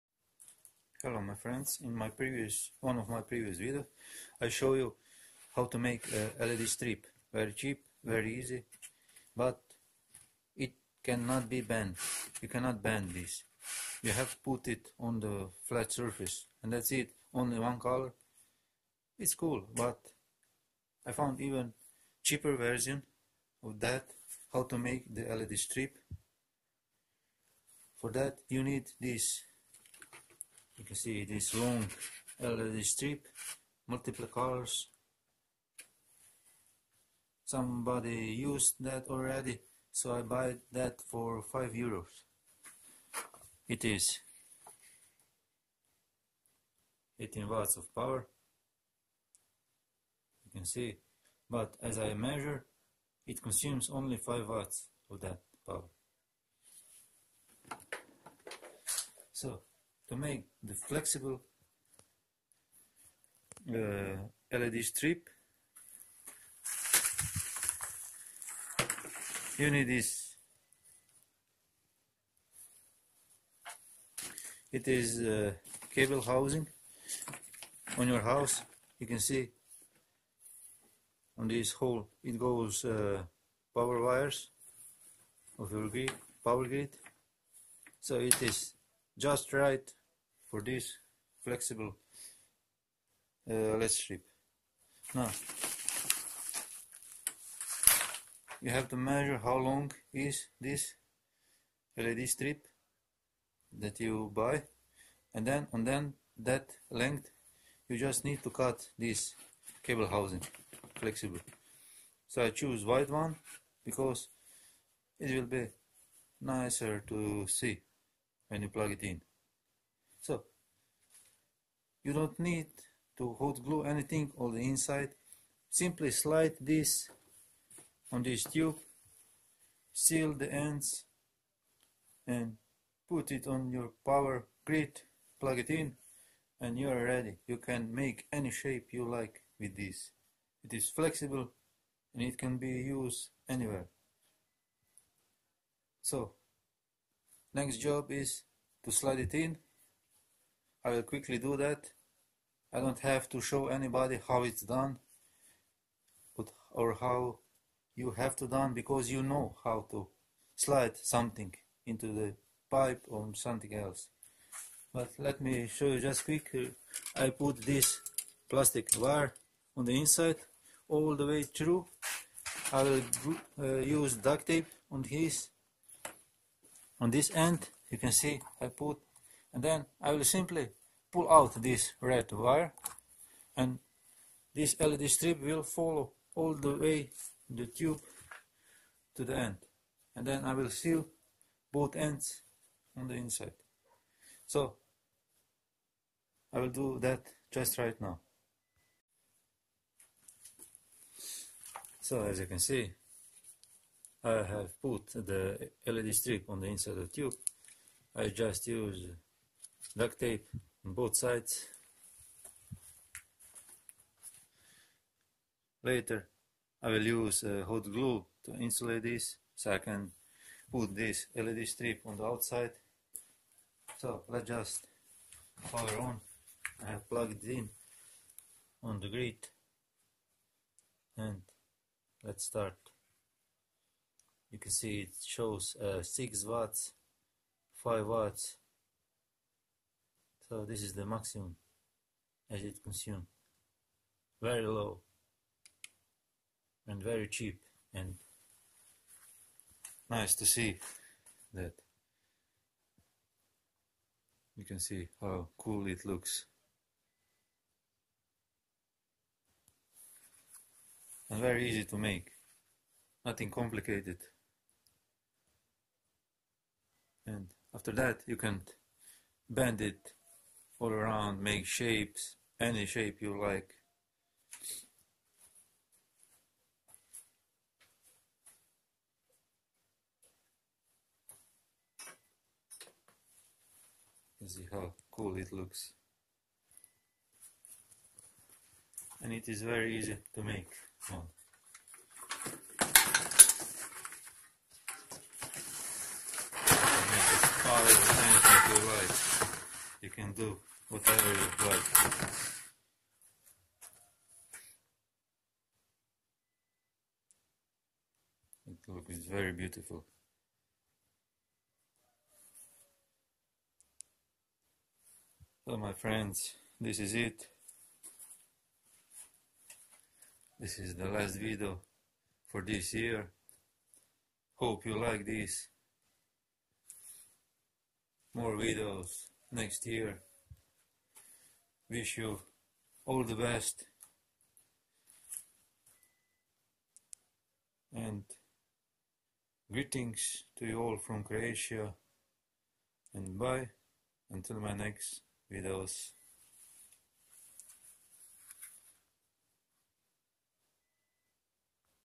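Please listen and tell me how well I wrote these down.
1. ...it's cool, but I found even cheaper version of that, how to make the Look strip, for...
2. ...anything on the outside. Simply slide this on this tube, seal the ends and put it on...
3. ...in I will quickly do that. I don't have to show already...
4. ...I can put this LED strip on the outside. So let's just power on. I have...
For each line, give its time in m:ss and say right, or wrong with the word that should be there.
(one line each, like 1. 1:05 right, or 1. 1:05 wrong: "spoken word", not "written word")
1. 0:19 wrong: "LED", not "Look"
2. 2:03 wrong: "inside", not "outside"
3. 2:29 wrong: "anybody", not "already"
4. 3:39 right.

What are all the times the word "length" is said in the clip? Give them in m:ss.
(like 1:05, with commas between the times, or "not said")
1:46.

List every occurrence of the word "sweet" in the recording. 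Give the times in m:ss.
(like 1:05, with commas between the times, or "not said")
not said.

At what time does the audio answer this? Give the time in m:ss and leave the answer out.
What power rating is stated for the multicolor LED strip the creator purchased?
0:47.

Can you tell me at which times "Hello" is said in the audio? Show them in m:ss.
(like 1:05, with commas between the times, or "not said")
0:01.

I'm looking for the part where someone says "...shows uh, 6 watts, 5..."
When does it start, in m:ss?
3:55.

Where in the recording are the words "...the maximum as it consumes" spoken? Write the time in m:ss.
4:00.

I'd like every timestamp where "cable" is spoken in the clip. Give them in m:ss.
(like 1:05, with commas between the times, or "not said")
1:15, 1:49.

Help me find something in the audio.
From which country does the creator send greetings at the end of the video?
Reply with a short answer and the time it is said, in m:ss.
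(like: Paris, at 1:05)
Croatia, at 5:41.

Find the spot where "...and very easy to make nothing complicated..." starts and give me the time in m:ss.
4:21.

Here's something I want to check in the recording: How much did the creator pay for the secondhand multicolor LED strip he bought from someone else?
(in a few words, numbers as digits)
5 euros.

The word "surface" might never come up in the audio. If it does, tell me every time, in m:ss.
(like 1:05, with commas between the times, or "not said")
0:15.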